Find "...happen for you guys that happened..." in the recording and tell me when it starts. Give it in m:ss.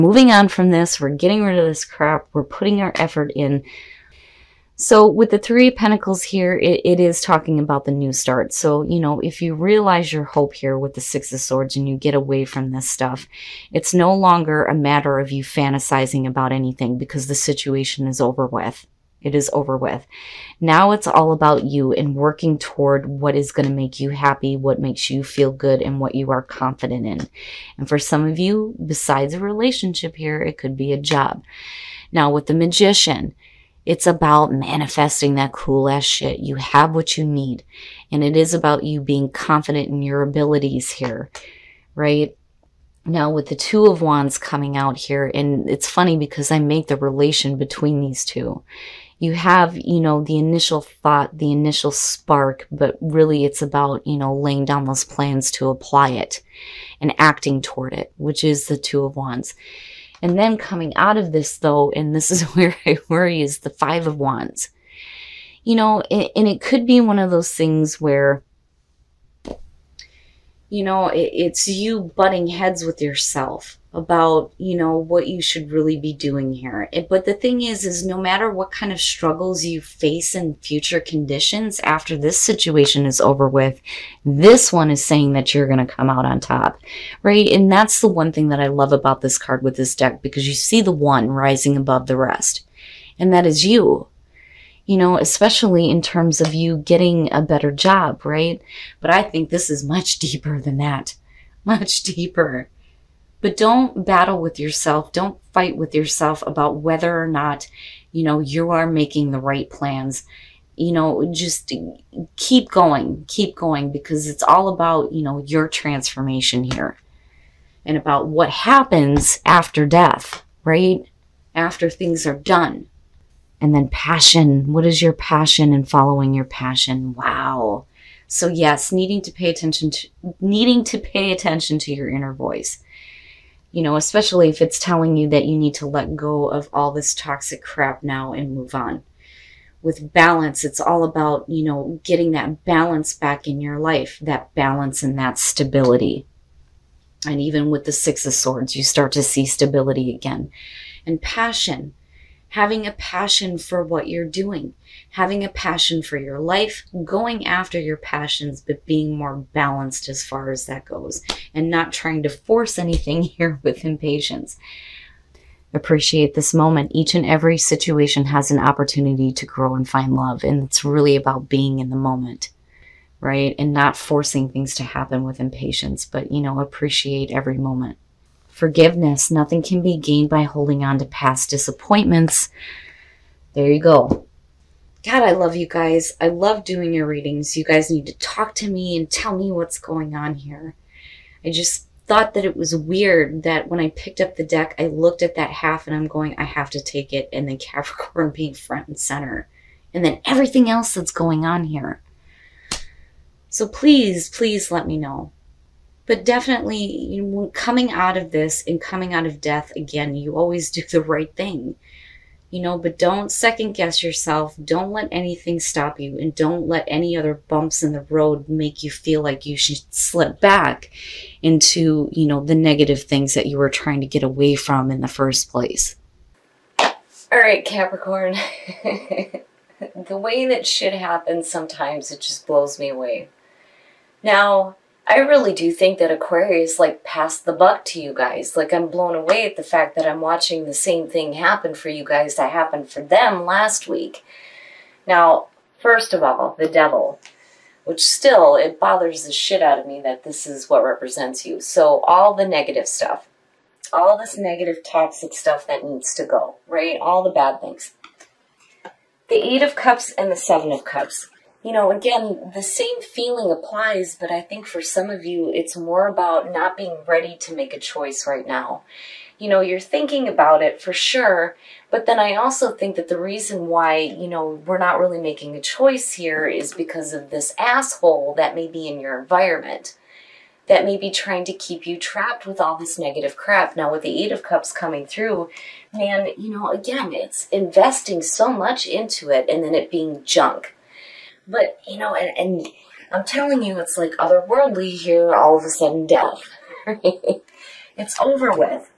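4:01.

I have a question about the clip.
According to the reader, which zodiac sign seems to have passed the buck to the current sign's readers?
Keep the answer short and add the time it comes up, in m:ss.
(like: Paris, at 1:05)
Aquarius, at 3:56.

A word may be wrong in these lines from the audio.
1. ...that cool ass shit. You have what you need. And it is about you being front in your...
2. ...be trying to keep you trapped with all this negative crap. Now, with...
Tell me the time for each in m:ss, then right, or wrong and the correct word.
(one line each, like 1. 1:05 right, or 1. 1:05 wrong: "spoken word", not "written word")
1. 0:35 wrong: "confident", not "front"
2. 4:40 right.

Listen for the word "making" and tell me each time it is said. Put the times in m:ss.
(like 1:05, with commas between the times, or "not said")
1:48, 4:35.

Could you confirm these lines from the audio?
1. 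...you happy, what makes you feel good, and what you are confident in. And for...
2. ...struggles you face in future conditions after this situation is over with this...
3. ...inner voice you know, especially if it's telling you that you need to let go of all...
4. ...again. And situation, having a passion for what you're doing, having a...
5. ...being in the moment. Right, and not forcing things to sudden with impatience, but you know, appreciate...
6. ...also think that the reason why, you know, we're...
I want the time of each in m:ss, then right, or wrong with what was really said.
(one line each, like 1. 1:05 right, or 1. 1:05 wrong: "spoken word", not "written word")
1. 0:23 right
2. 1:18 right
3. 2:12 right
4. 2:30 wrong: "passion", not "situation"
5. 2:51 wrong: "happen", not "sudden"
6. 4:32 right.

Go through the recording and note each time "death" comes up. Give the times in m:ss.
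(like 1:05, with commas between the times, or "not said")
1:59, 3:29, 4:56.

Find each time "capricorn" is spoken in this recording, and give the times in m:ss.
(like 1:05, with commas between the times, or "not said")
3:17, 3:47.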